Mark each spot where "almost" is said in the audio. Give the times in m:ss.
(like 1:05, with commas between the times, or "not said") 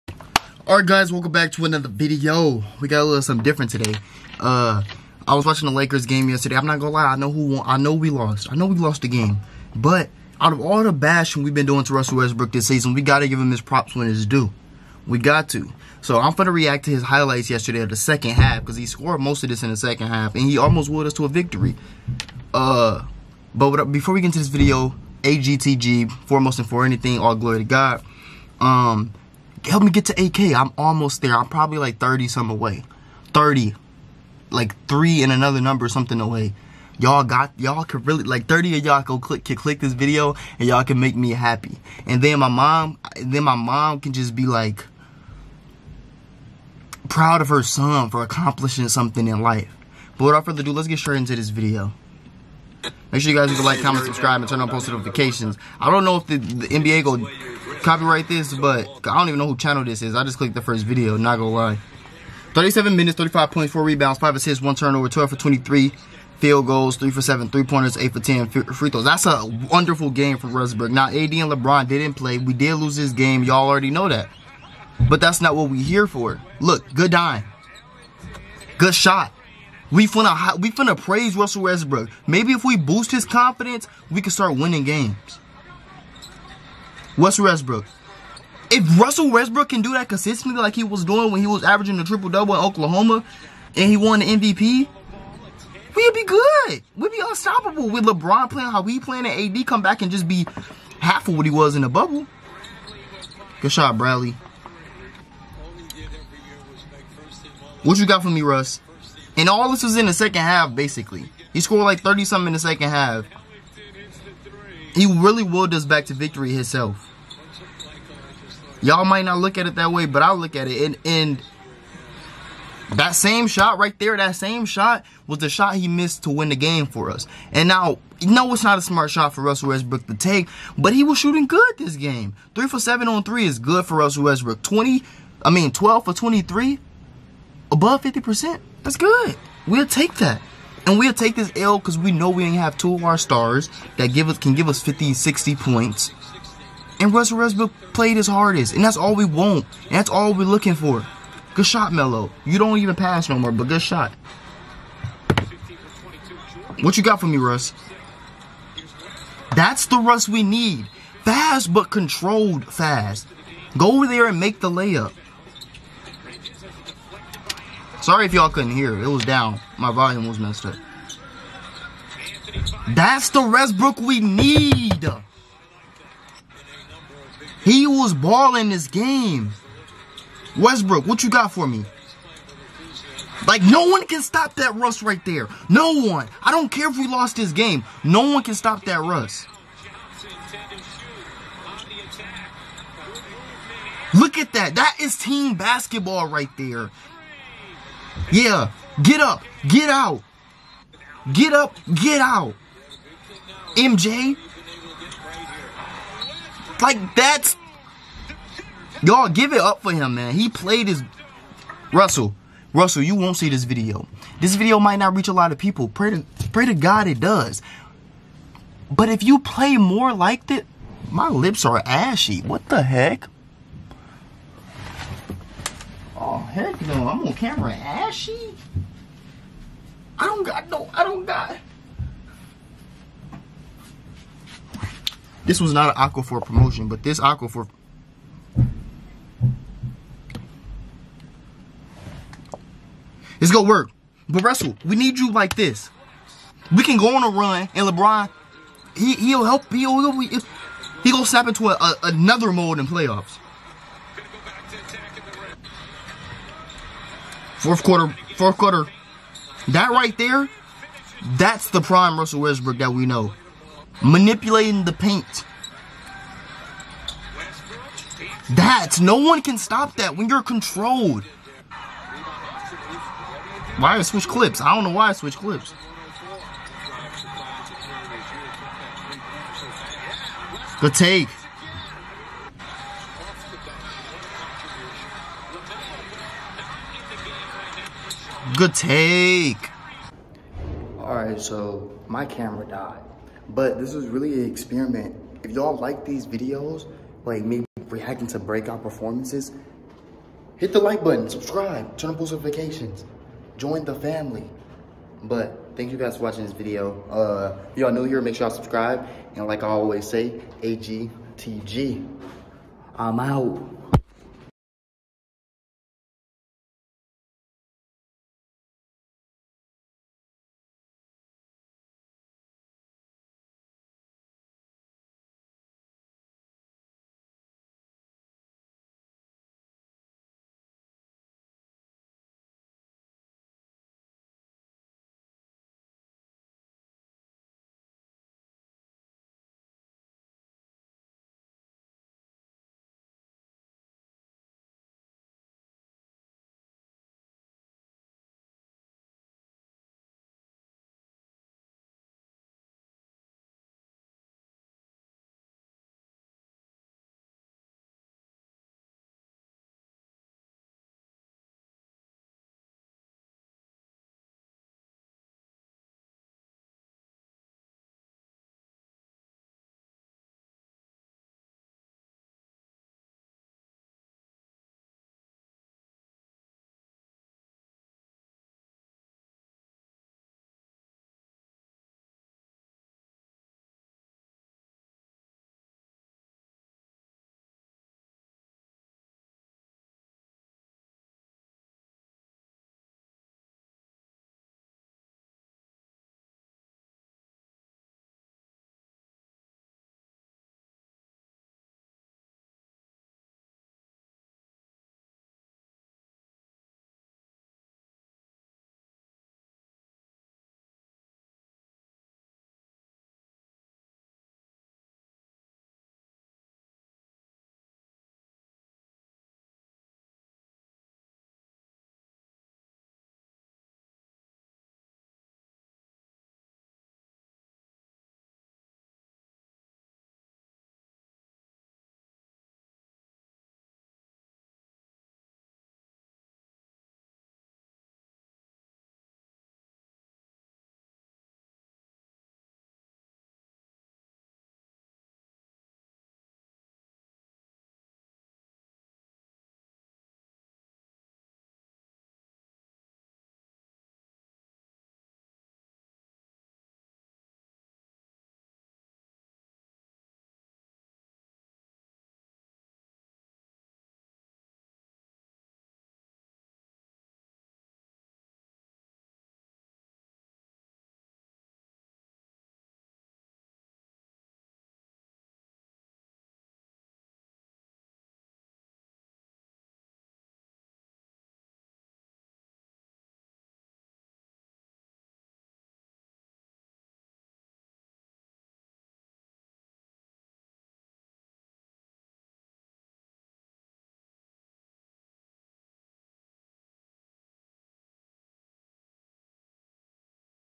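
0:20, 0:30.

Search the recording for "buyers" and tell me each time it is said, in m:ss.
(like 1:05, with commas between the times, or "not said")
not said.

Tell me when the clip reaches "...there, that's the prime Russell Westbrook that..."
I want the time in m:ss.
4:20.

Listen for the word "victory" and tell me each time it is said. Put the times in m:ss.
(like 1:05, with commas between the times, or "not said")
0:21, 1:56.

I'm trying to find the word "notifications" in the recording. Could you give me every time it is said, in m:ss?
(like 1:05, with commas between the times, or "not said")
0:54, 5:02.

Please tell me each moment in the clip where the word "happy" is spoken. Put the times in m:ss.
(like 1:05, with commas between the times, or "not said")
0:41.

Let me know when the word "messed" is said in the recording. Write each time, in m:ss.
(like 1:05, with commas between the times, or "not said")
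2:50.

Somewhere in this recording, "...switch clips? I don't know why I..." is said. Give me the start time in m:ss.
4:34.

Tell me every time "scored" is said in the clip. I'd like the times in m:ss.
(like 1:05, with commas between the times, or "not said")
0:18, 1:51.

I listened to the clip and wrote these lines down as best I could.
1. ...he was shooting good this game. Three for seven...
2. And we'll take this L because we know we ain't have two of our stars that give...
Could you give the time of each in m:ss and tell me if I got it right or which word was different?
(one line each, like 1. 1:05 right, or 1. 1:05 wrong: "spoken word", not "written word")
1. 2:10 right
2. 2:20 right.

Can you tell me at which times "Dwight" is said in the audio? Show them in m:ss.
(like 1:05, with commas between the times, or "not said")
not said.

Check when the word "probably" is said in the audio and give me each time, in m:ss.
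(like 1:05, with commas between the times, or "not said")
0:31.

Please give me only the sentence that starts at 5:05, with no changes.
But thank you guys for watching this video.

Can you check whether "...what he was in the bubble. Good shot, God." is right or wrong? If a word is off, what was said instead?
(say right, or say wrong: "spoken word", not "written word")
wrong: "Bradley", not "God".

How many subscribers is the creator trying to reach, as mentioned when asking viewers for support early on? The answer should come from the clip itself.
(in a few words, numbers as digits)
8K.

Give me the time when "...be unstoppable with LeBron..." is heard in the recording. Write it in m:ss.
1:37.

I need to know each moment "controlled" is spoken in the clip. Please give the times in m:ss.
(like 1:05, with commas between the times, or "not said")
2:41, 4:30.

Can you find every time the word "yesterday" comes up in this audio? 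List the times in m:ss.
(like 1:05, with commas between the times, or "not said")
0:06, 0:17.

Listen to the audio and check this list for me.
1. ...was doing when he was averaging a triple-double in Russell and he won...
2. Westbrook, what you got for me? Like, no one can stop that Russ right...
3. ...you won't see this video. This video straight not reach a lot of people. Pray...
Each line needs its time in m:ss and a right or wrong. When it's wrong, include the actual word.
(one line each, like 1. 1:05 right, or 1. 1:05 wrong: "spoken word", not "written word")
1. 1:30 wrong: "Oklahoma", not "Russell"
2. 3:00 right
3. 3:33 wrong: "might", not "straight".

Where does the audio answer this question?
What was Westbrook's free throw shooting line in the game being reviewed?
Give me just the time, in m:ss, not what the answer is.
1:07.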